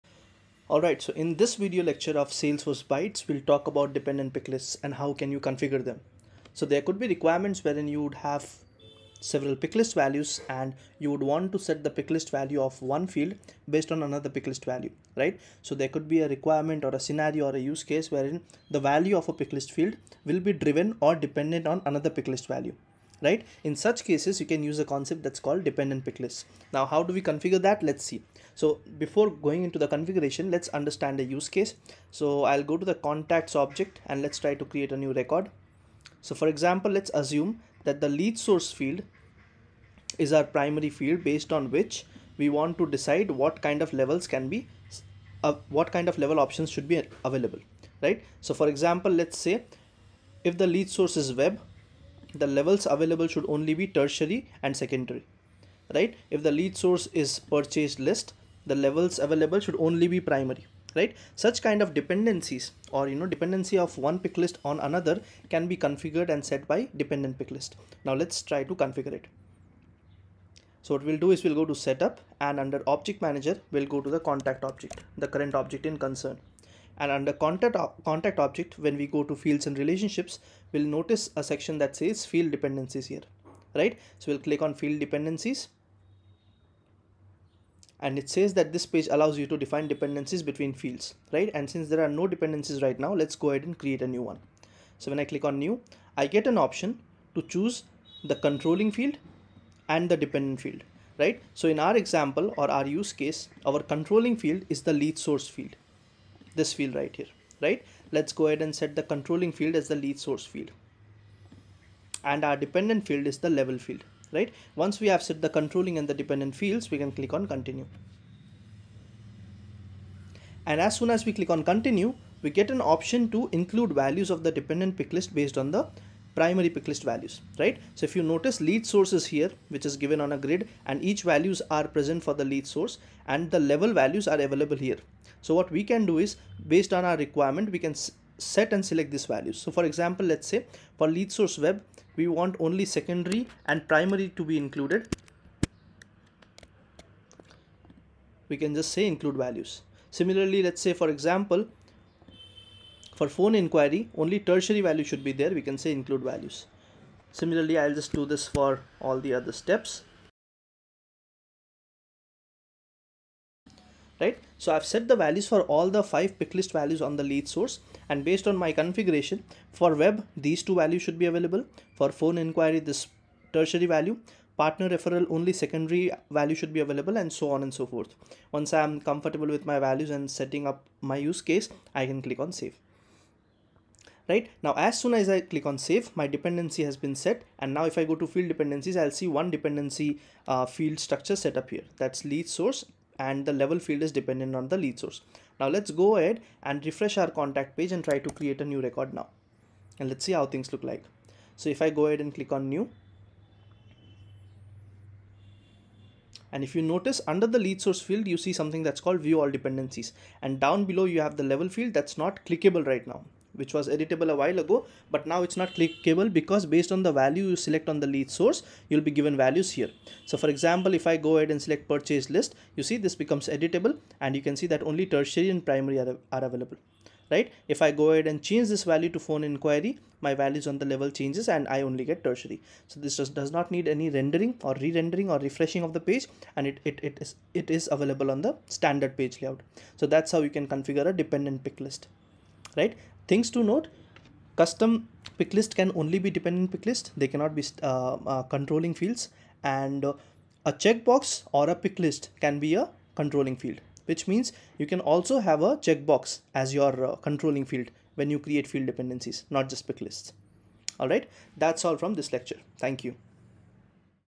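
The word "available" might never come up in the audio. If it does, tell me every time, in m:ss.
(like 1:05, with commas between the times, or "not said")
0:47, 0:52, 0:59, 2:14, 2:51, 2:56, 3:46, 3:57.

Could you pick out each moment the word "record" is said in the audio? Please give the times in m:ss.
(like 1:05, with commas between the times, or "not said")
0:35, 3:18.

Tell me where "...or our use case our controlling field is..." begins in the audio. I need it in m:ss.
1:42.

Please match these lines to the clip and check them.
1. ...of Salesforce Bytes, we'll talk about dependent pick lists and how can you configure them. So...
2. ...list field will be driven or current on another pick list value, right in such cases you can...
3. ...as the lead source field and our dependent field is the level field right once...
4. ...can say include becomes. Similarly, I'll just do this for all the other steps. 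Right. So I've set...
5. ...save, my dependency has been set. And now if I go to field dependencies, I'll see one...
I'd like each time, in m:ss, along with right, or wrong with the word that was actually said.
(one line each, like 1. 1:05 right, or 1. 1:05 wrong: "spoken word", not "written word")
1. 0:02 right
2. 0:19 wrong: "dependent", not "current"
3. 1:49 right
4. 2:35 wrong: "values", not "becomes"
5. 3:05 right.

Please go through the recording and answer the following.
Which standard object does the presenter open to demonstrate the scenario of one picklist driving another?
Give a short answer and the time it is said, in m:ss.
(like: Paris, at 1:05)
Contacts, at 0:32.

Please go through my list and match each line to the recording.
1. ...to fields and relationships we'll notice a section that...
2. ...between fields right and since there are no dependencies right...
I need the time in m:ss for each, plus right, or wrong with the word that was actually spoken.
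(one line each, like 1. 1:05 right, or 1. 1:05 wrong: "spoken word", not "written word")
1. 1:19 right
2. 1:30 right.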